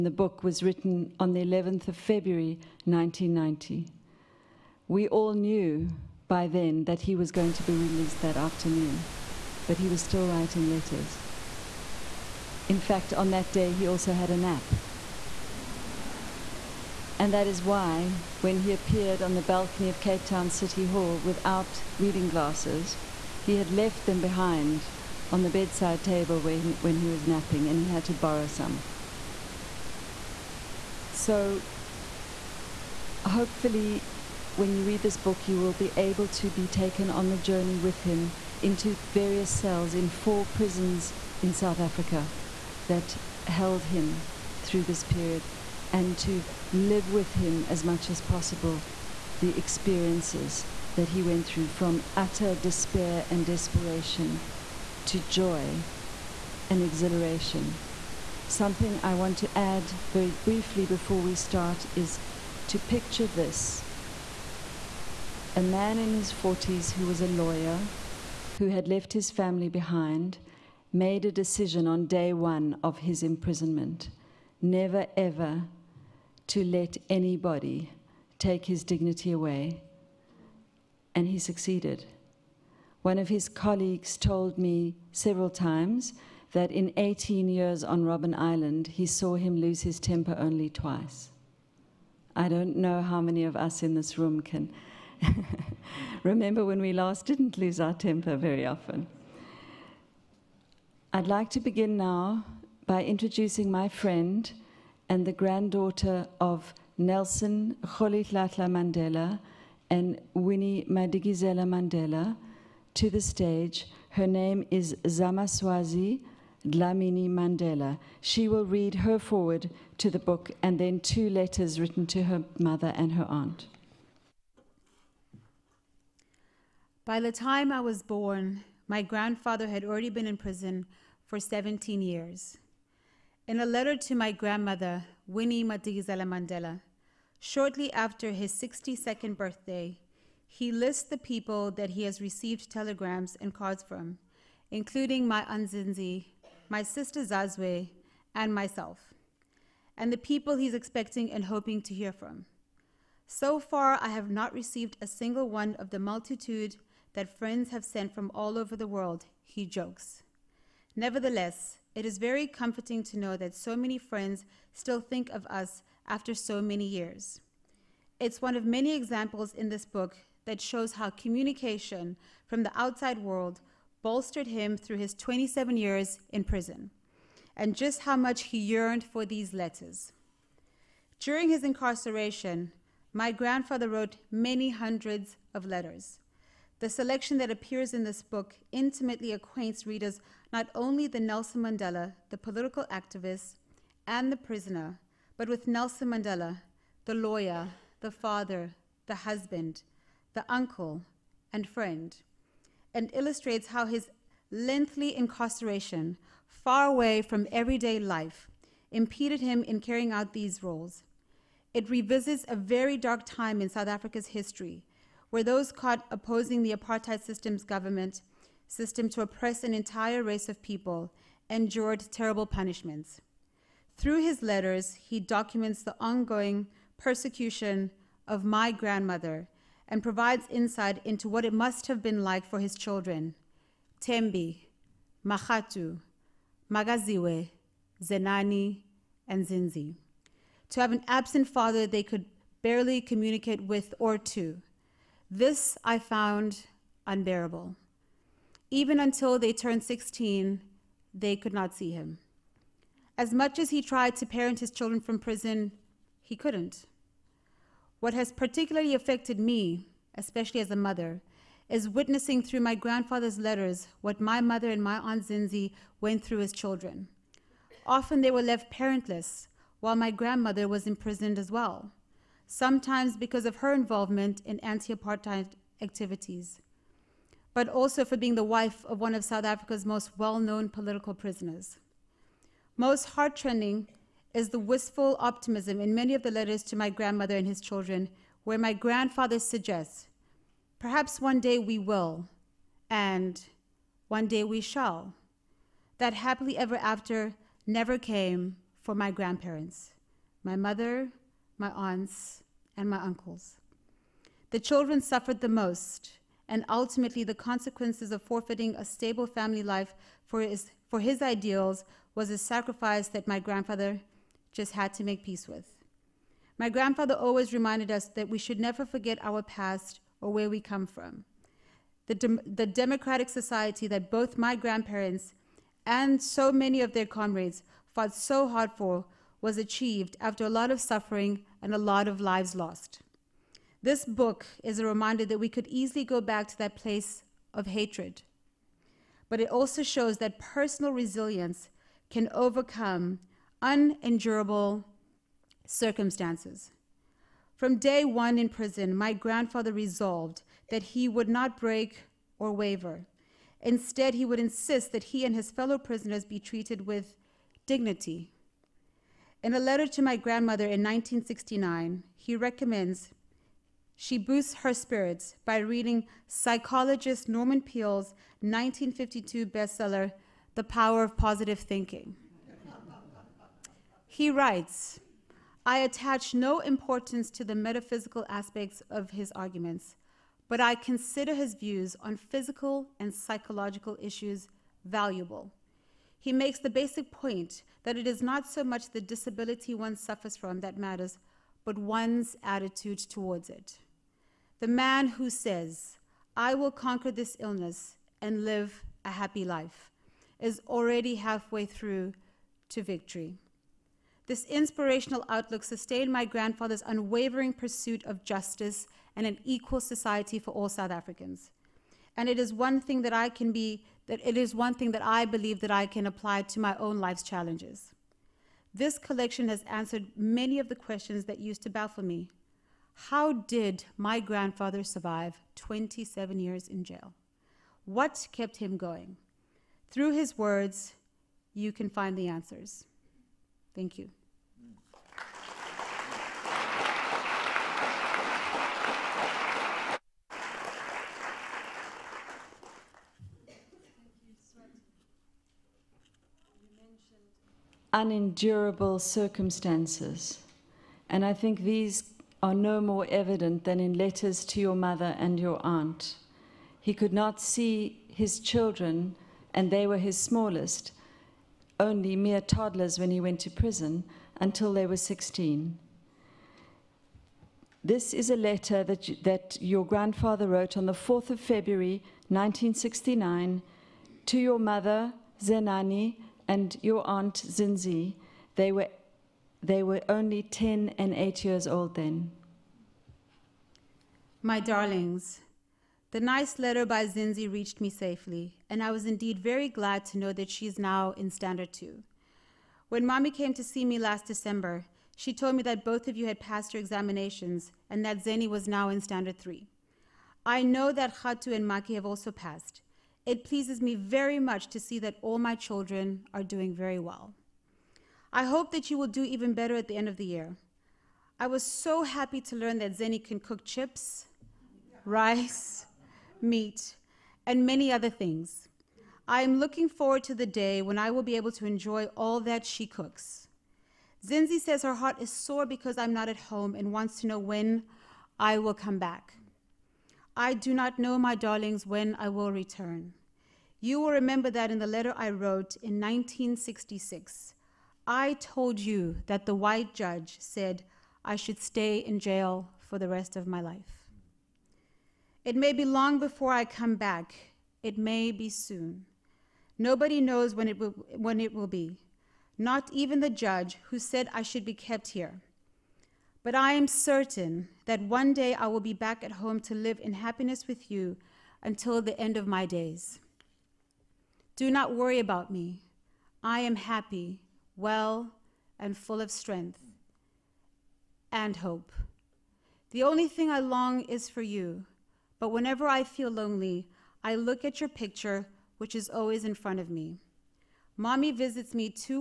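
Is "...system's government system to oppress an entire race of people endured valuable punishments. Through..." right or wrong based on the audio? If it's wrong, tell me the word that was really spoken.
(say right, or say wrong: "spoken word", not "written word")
wrong: "terrible", not "valuable".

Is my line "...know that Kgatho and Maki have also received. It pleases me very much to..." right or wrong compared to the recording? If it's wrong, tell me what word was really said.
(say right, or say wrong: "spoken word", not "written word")
wrong: "passed", not "received".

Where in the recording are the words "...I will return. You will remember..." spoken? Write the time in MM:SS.
08:52.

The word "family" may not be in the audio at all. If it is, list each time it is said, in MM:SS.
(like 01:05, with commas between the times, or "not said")
01:09, 05:09.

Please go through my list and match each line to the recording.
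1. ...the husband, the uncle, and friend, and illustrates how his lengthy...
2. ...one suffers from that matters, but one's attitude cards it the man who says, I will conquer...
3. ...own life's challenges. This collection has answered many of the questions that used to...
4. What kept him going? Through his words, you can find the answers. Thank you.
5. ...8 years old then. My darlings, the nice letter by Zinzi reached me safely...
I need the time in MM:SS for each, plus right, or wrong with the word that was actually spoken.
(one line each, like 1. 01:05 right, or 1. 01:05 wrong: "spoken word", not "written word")
1. 03:19 right
2. 06:29 wrong: "towards", not "cards"
3. 06:56 right
4. 07:07 right
5. 08:01 right.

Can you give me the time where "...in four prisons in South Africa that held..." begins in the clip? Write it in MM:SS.
00:39.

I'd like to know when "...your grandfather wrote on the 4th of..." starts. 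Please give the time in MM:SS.
07:49.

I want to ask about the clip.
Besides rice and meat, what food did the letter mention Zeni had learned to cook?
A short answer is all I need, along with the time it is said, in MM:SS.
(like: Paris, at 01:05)
chips, at 08:33.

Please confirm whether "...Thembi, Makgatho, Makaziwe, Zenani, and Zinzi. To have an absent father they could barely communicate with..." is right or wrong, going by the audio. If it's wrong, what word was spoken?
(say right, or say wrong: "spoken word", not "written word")
right.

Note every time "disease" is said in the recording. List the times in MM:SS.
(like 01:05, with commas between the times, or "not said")
not said.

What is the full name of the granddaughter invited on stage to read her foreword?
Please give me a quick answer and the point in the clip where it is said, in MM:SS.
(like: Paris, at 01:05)
Zamaswazi Dlamini Mandela, at 01:55.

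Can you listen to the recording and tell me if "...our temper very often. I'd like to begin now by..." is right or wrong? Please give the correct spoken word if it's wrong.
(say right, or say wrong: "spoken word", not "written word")
right.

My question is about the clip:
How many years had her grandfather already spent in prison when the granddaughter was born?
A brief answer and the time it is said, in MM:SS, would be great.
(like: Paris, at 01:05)
17, at 02:11.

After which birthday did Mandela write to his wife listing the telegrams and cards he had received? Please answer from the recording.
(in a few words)
62nd.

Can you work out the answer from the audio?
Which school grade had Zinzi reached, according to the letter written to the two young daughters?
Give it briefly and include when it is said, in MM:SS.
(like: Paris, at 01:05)
Standard 2, at 08:11.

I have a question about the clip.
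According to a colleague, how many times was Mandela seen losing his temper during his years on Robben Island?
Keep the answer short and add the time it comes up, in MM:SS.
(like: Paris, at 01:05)
twice, at 01:30.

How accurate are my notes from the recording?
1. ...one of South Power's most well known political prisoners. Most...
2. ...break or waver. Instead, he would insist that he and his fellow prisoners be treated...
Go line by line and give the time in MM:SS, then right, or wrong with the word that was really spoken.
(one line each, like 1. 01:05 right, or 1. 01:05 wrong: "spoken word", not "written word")
1. 04:38 wrong: "Africa", not "Power"
2. 05:51 right.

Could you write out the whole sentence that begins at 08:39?
I am looking forward to the day when I will be able to enjoy all that she cooks.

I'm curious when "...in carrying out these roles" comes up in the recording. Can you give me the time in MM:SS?
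03:29.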